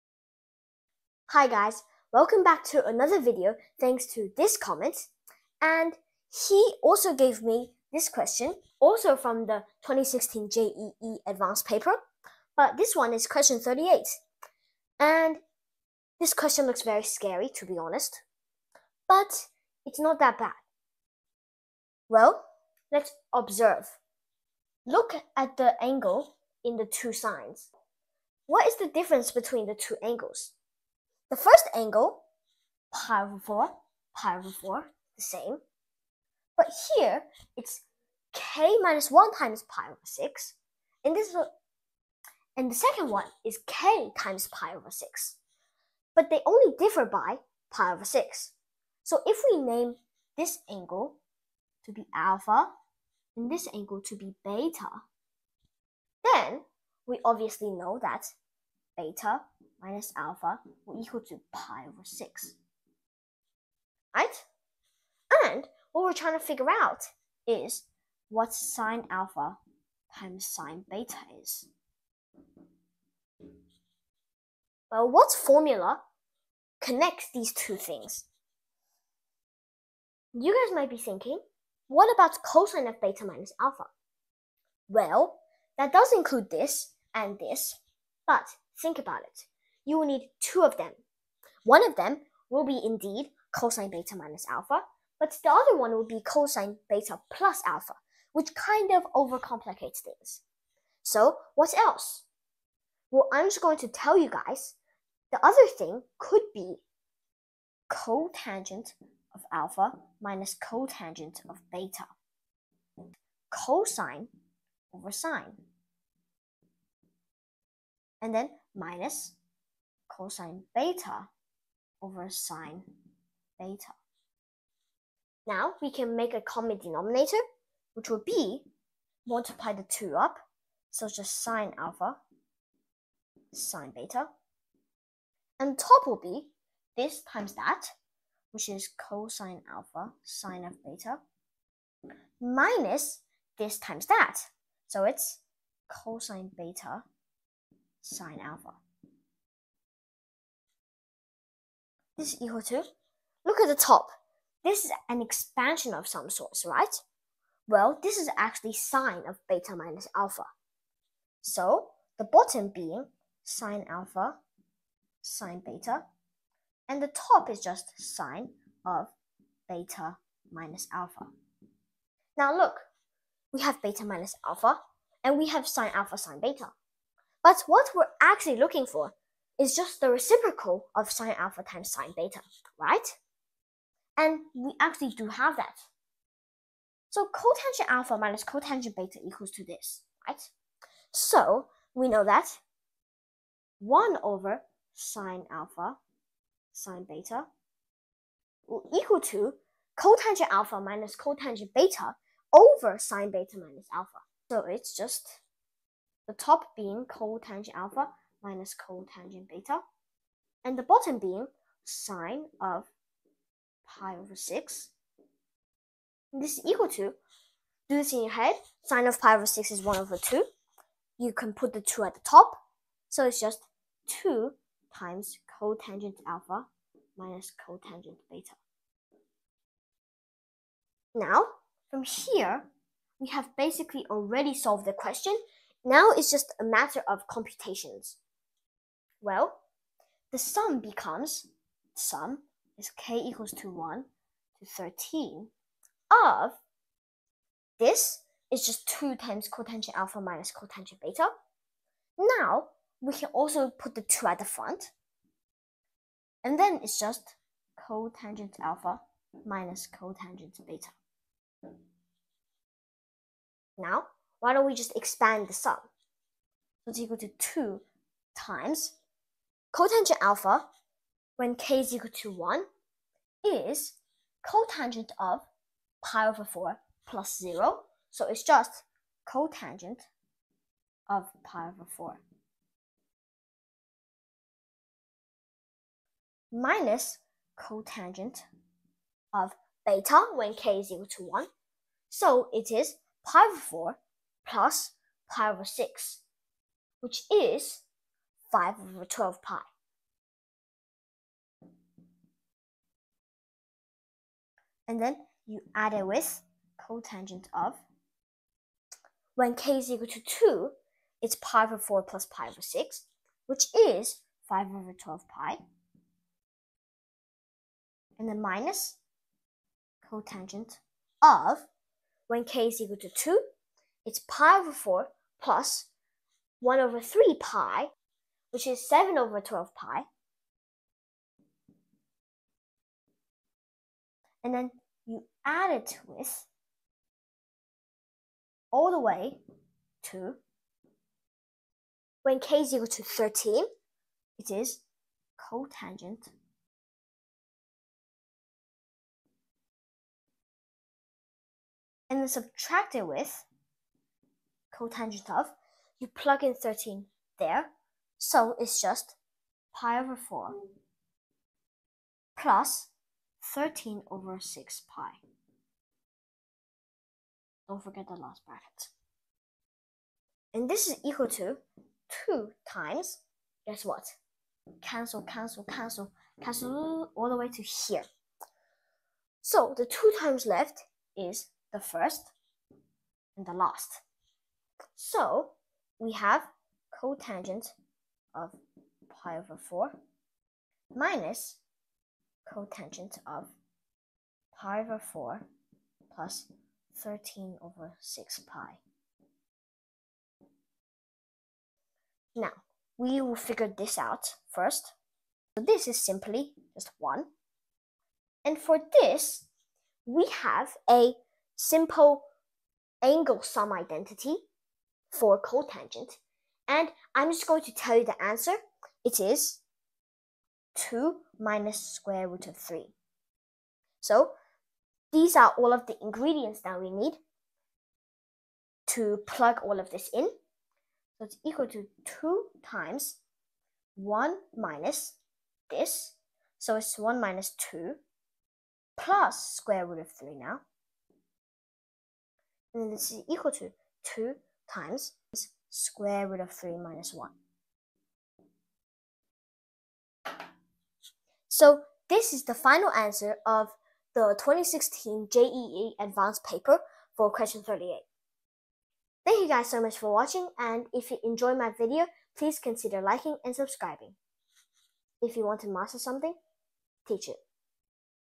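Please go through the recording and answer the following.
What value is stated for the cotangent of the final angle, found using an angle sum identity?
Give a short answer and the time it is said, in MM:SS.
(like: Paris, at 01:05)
2 minus root 3, at 07:00.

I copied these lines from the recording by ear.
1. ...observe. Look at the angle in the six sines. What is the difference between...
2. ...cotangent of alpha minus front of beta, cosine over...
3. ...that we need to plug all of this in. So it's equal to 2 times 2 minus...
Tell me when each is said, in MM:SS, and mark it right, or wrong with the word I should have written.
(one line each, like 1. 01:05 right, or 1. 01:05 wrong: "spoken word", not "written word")
1. 00:23 wrong: "two", not "six"
2. 01:47 wrong: "cotangent", not "front"
3. 07:06 wrong: "1", not "2".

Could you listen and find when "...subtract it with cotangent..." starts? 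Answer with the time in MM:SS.
05:52.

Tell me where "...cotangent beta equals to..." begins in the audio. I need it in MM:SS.
03:08.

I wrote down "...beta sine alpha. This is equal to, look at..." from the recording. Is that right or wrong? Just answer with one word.
right.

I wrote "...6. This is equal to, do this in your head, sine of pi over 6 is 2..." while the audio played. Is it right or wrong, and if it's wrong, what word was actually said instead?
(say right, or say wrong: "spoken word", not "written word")
wrong: "1", not "2".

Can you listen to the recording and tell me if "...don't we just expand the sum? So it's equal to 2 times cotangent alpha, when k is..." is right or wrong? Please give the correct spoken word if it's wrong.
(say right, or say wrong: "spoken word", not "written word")
right.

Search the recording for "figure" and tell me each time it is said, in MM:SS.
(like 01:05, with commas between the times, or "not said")
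01:06, 06:43.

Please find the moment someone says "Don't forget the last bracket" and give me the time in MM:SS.
06:07.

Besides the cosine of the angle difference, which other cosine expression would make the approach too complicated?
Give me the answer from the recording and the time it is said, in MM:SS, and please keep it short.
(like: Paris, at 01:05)
cosine beta plus alpha, at 01:36.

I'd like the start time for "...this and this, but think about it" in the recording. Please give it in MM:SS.
01:26.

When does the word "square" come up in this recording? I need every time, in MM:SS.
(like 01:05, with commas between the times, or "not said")
07:01, 07:19, 07:25.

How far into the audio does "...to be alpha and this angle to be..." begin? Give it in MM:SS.
00:51.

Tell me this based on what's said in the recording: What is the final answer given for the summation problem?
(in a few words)
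2(√3 − 1).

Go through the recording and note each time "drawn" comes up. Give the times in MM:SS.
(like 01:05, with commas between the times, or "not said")
not said.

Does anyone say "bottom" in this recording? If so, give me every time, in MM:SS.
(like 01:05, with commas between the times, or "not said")
02:42, 03:30.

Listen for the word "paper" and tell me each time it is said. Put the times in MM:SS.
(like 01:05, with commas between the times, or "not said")
00:11, 07:36.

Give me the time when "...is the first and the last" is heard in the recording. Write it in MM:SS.
06:21.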